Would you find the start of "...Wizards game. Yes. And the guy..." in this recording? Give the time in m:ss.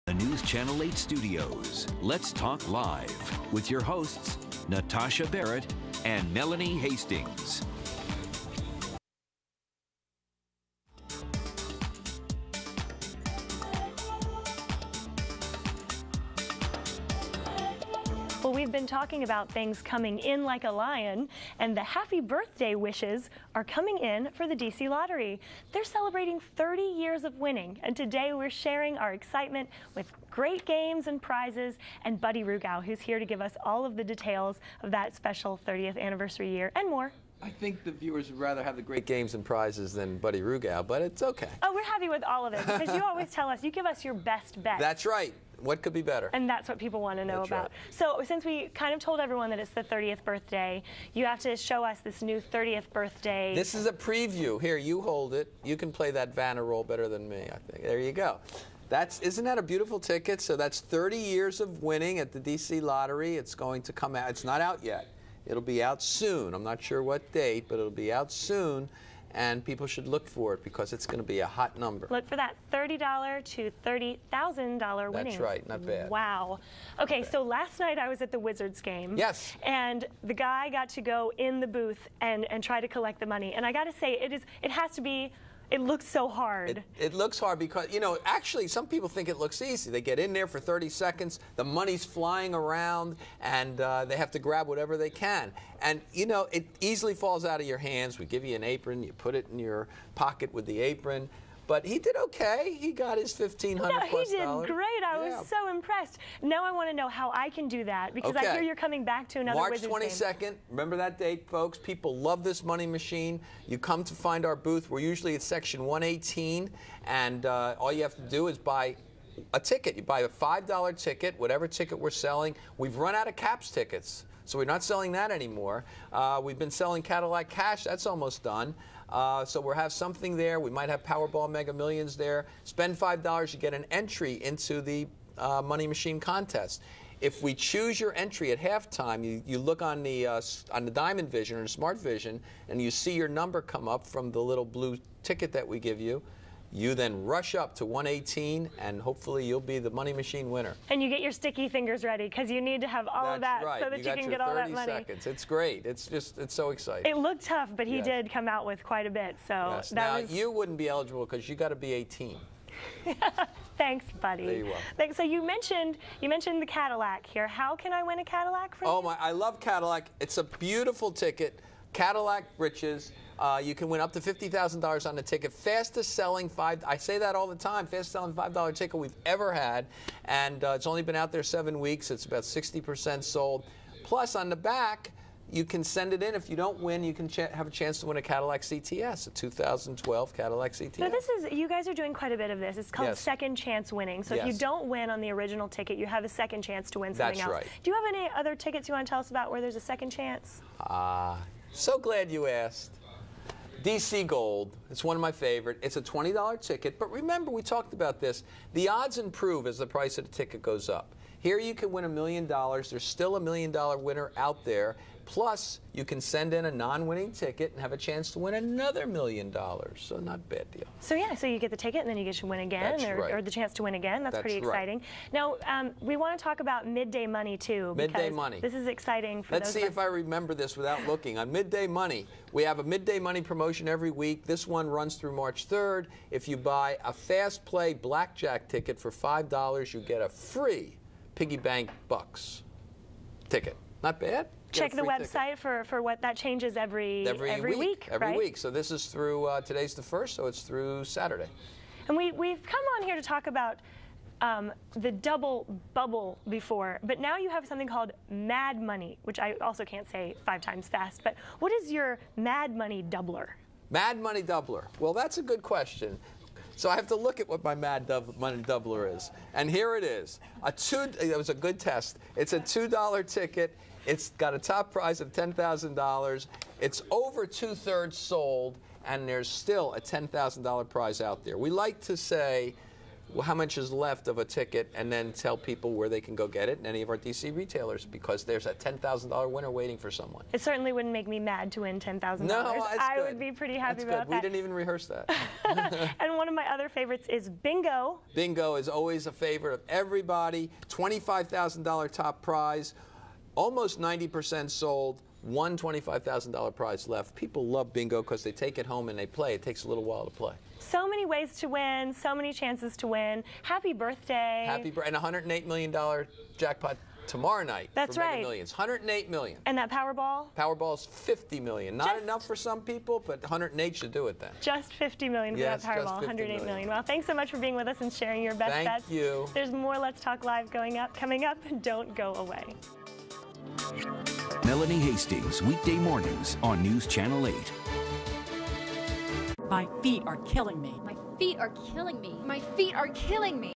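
1:18.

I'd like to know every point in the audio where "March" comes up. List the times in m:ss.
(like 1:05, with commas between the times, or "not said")
1:49, 3:55.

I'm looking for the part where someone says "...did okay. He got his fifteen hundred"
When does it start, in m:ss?
1:41.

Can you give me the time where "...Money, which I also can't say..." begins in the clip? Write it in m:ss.
4:18.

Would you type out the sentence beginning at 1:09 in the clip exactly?
And people should look for it because it's going to be a hot number.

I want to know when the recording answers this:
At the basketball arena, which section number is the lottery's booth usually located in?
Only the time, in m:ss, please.
1:55.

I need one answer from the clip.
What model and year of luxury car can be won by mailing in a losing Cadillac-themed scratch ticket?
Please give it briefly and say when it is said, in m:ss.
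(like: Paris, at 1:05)
2012 Cadillac CTS, at 3:09.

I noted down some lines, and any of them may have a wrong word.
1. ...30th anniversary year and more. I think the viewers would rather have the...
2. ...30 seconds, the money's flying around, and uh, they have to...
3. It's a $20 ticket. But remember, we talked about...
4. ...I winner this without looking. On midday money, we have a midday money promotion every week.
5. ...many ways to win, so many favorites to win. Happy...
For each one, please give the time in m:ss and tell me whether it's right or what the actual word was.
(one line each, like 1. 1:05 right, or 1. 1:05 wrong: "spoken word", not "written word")
1. 0:35 right
2. 1:30 right
3. 3:25 right
4. 3:49 wrong: "remember", not "winner"
5. 5:11 wrong: "chances", not "favorites".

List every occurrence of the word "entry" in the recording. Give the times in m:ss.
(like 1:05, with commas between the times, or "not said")
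2:13, 2:18.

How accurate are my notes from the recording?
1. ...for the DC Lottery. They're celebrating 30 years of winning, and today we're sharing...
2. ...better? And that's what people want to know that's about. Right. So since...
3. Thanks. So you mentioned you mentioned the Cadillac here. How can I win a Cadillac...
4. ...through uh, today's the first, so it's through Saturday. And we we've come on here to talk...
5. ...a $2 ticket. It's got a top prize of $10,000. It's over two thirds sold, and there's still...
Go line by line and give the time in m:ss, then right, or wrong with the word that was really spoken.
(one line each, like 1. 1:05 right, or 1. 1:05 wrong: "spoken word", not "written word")
1. 0:24 right
2. 0:46 right
3. 2:44 right
4. 4:09 right
5. 4:32 right.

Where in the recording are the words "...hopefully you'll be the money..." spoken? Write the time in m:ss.
2:29.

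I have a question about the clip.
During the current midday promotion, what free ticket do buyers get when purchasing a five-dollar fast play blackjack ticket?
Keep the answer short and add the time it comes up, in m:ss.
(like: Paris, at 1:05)
Piggy Bank Bucks, at 4:01.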